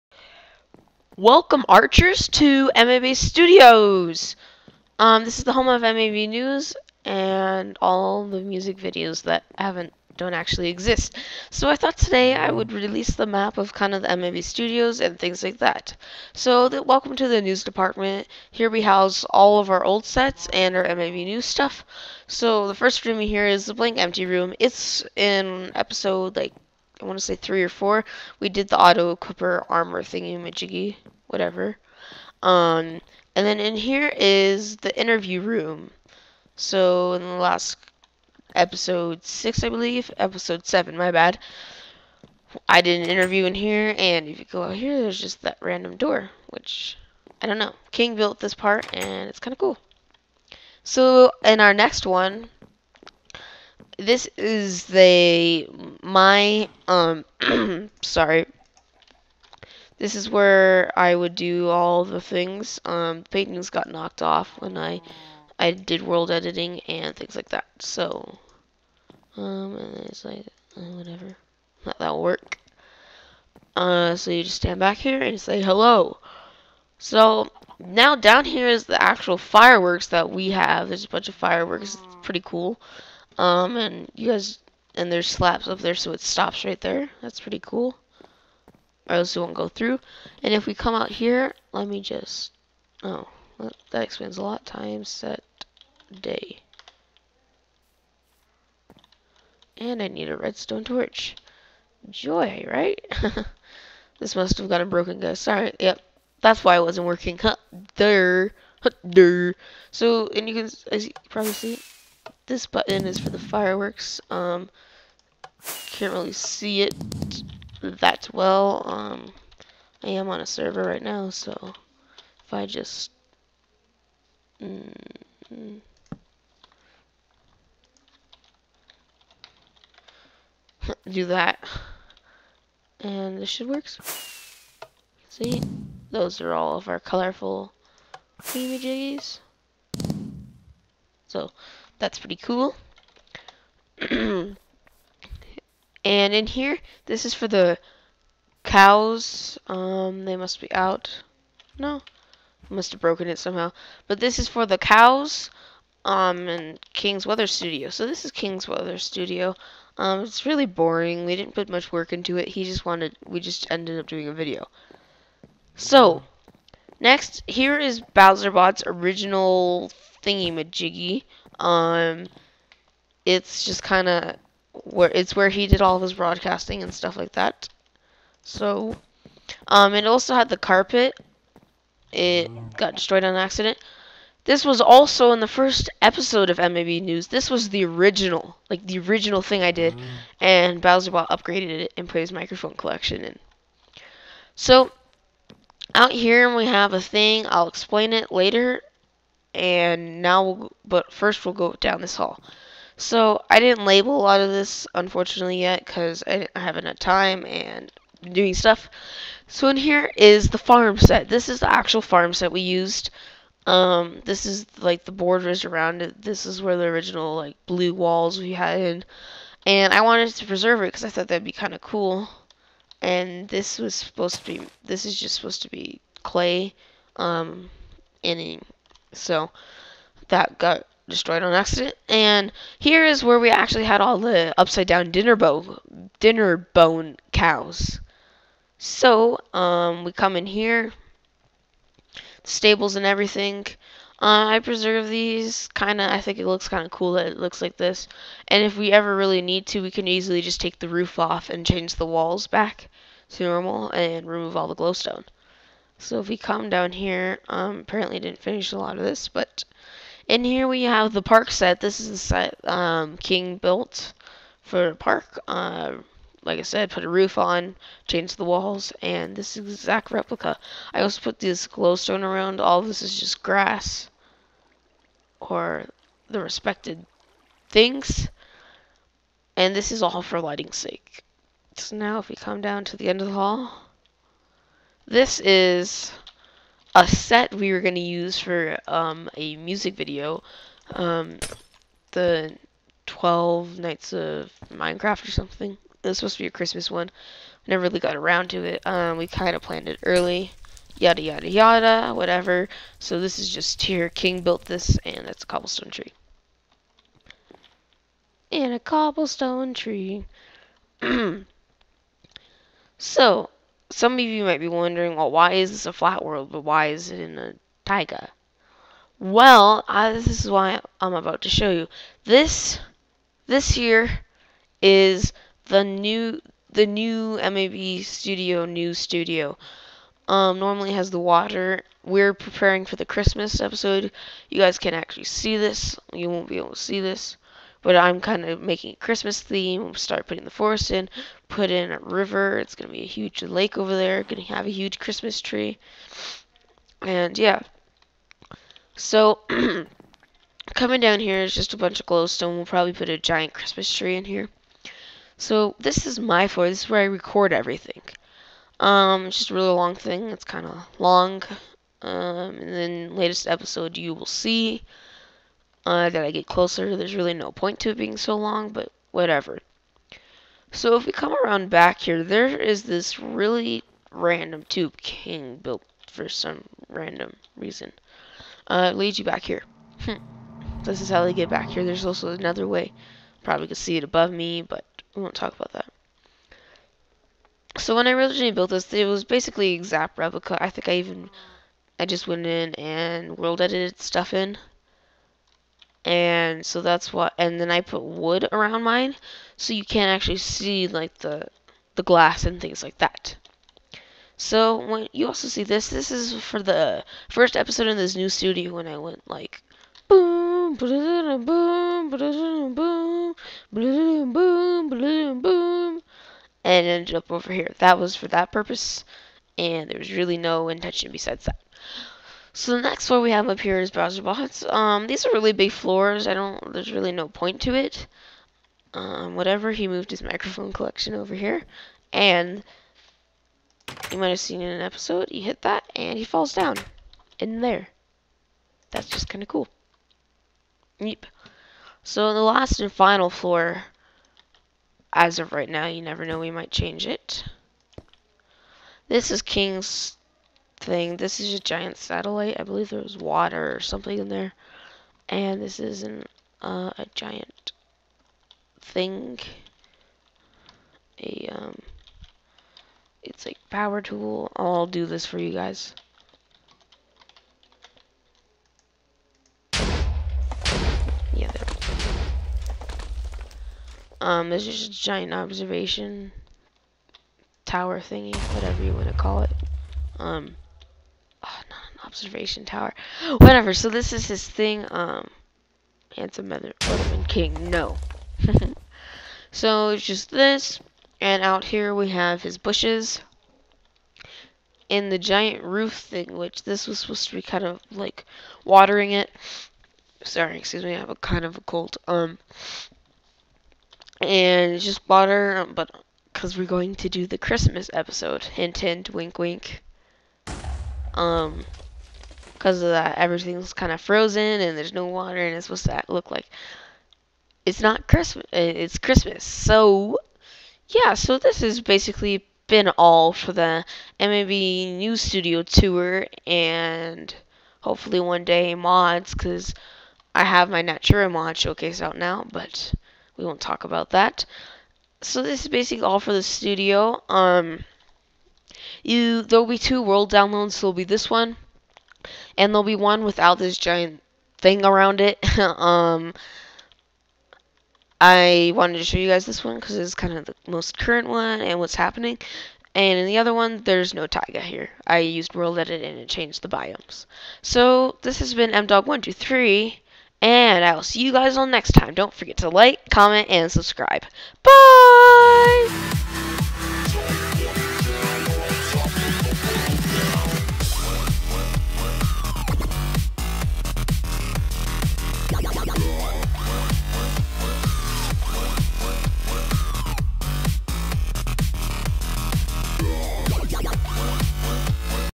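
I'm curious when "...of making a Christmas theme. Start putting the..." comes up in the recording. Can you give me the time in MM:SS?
05:38.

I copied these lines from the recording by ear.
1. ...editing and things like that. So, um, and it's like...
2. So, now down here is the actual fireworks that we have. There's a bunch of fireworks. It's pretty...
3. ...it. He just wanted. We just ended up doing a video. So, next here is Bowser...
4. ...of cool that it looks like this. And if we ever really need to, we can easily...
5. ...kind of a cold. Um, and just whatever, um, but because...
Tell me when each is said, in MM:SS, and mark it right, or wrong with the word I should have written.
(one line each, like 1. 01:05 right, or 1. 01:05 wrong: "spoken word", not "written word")
1. 01:06 right
2. 01:16 right
3. 02:42 right
4. 04:06 right
5. 08:21 wrong: "water", not "whatever".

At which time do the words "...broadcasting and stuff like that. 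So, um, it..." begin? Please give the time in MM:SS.
02:56.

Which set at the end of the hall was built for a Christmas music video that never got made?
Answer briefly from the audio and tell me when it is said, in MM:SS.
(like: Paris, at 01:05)
The 12 Nights of Minecraft, at 04:53.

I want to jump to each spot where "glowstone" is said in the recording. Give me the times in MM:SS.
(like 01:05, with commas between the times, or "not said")
04:14, 04:31, 05:52.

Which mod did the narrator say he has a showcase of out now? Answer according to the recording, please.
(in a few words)
Natura.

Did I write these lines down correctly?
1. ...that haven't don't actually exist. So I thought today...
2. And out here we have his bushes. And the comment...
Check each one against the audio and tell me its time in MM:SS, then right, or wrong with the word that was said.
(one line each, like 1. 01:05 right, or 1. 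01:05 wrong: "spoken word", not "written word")
1. 00:09 right
2. 08:11 wrong: "giant", not "comment".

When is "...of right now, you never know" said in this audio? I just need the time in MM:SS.
07:25.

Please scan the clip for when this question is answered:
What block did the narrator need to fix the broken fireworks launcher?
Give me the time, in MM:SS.
01:40.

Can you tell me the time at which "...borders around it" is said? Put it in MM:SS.
03:35.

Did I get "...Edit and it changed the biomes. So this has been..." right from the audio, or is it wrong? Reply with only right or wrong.
right.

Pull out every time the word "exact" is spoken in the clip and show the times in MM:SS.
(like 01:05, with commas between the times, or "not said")
04:29, 06:29.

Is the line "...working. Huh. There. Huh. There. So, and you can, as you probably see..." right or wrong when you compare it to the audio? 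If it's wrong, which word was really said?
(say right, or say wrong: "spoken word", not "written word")
right.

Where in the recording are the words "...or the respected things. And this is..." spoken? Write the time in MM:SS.
04:35.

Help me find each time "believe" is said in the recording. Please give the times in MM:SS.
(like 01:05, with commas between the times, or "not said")
00:39, 07:32.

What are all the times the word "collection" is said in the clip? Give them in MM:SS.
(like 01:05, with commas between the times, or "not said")
03:12, 07:10.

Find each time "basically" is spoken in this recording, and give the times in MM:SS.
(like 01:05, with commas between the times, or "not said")
06:29, 08:41, 08:55.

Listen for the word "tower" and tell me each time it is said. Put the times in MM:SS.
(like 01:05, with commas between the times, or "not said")
07:57, 08:02.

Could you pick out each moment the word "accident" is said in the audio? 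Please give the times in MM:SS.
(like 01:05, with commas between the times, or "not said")
03:03, 03:51.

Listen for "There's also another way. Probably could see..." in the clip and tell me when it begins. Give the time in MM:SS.
06:21.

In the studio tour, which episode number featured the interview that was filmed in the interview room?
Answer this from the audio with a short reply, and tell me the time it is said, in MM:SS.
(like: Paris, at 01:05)
7, at 00:40.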